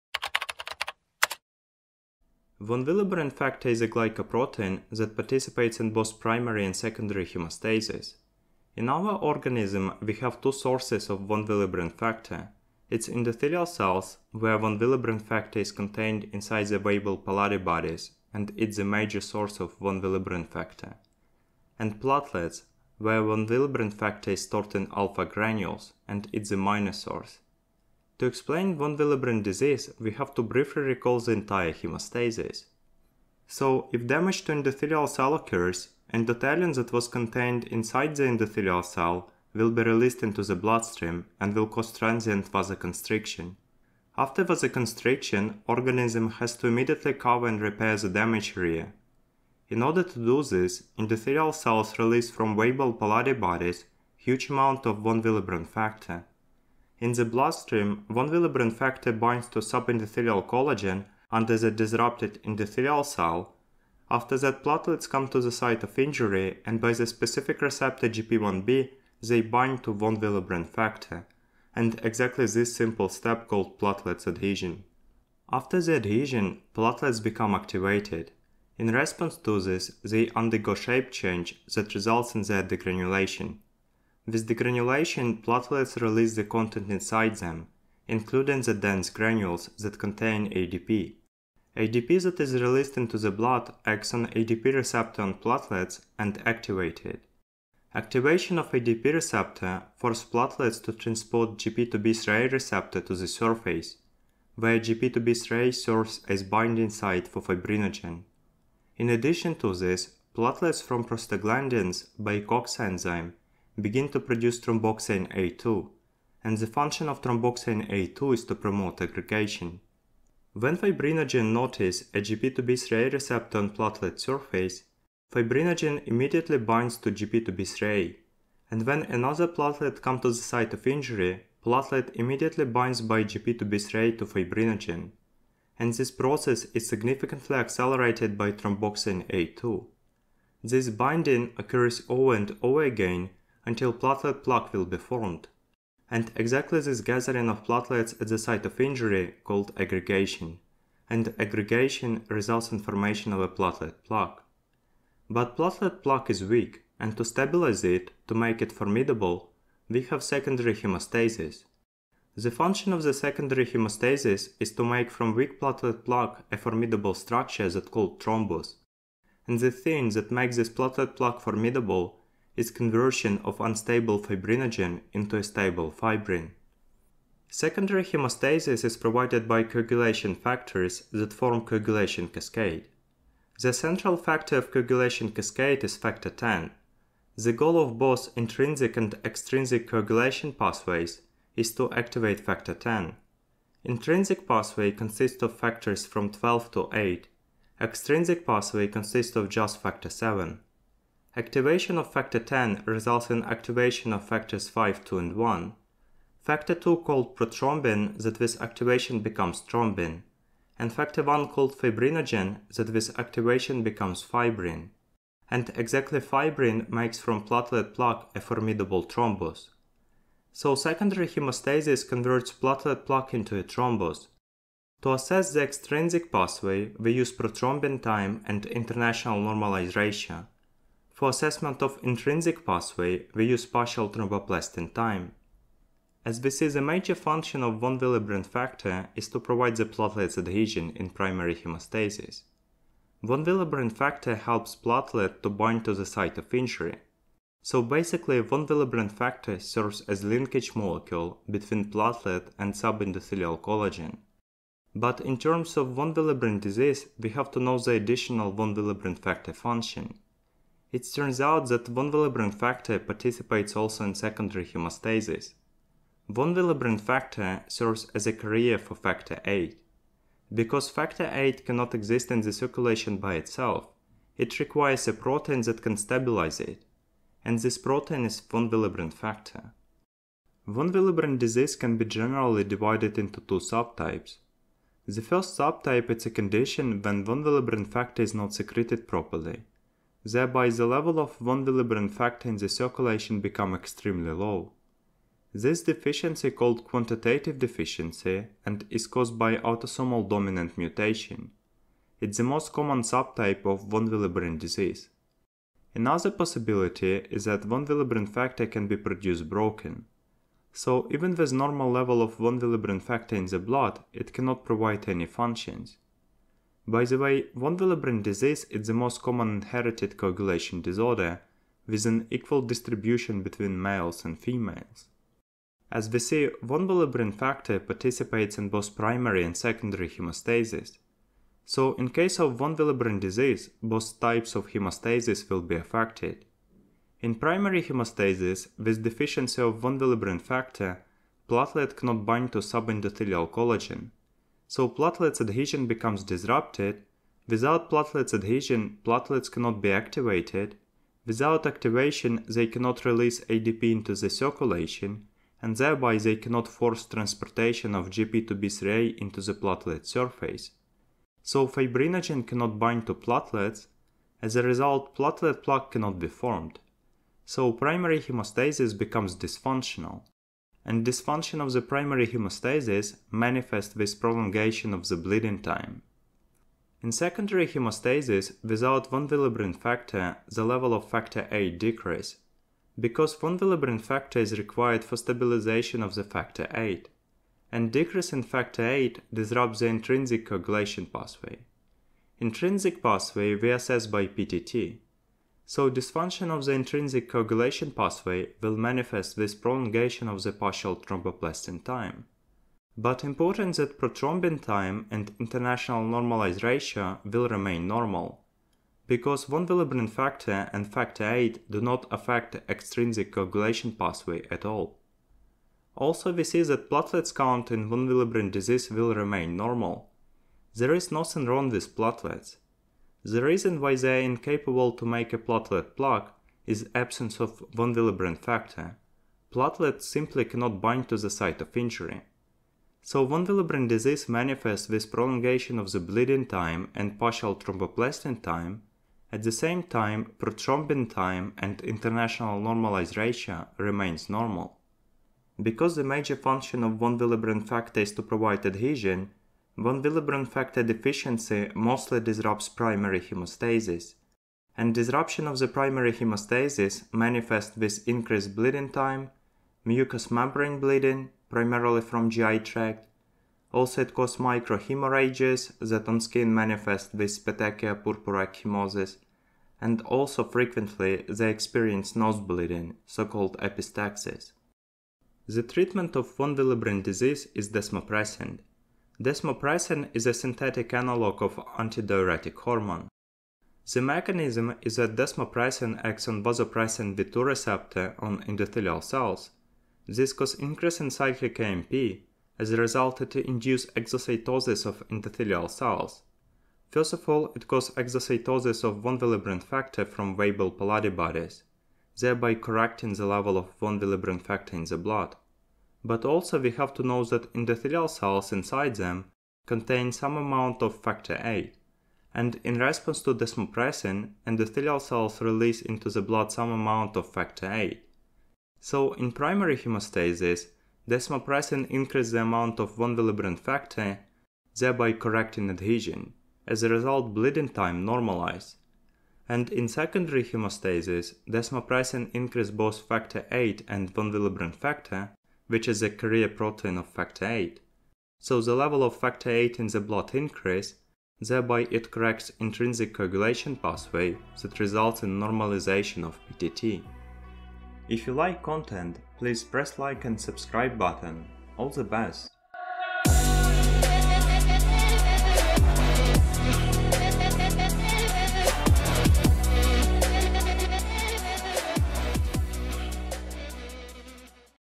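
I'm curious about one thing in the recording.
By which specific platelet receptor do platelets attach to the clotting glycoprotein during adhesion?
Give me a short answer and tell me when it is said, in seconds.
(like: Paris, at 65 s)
GP1b, at 68 s.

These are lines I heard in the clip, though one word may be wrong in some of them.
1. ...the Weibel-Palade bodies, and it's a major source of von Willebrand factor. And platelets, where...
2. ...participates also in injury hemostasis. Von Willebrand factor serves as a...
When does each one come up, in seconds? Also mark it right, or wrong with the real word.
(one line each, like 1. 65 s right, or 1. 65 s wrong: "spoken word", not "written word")
1. 16 s right
2. 262 s wrong: "secondary", not "injury".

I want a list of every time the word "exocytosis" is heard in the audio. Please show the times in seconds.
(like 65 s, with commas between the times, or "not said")
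493 s, 497 s.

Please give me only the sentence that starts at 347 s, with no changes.
Without platelets adhesion, platelets cannot be activated.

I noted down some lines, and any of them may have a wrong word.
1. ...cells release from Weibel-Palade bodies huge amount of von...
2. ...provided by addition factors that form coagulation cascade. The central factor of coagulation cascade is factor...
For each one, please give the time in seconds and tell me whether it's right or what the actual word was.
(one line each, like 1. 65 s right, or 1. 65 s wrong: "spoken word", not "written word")
1. 51 s right
2. 178 s wrong: "coagulation", not "addition".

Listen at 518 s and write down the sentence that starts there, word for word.
So in primary hemostasis, desmopressin increases the amount of von Willebrand factor, thereby correcting adhesion.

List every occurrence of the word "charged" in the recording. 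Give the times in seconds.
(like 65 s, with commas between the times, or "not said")
not said.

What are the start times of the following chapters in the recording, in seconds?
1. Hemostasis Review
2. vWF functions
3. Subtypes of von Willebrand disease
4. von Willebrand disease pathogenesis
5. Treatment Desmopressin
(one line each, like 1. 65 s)
1. 30 s
2. 236 s
3. 280 s
4. 328 s
5. 475 s.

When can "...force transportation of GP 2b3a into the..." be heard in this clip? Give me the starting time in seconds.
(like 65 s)
356 s.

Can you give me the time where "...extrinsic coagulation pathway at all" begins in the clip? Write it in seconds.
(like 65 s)
412 s.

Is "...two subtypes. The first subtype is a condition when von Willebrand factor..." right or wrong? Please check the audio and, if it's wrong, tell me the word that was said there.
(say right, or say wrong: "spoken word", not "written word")
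right.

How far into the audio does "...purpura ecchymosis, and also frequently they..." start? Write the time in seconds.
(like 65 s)
467 s.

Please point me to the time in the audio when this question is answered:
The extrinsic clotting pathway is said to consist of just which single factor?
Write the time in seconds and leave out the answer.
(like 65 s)
199 s.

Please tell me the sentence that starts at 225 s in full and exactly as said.
To assess the extrinsic pathway, we use prothrombin time and international normalized ratio.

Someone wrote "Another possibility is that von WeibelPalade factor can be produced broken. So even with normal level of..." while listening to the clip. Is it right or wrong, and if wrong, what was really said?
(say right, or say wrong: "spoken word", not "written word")
wrong: "Willebrand", not "WeibelPalade".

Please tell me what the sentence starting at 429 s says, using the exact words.
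Platelets simply cannot bind to the site of injury.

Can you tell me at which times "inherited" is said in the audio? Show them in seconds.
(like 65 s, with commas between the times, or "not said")
319 s.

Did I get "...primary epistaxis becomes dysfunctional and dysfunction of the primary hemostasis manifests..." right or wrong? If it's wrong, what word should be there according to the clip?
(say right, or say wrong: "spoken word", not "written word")
wrong: "hemostasis", not "epistaxis".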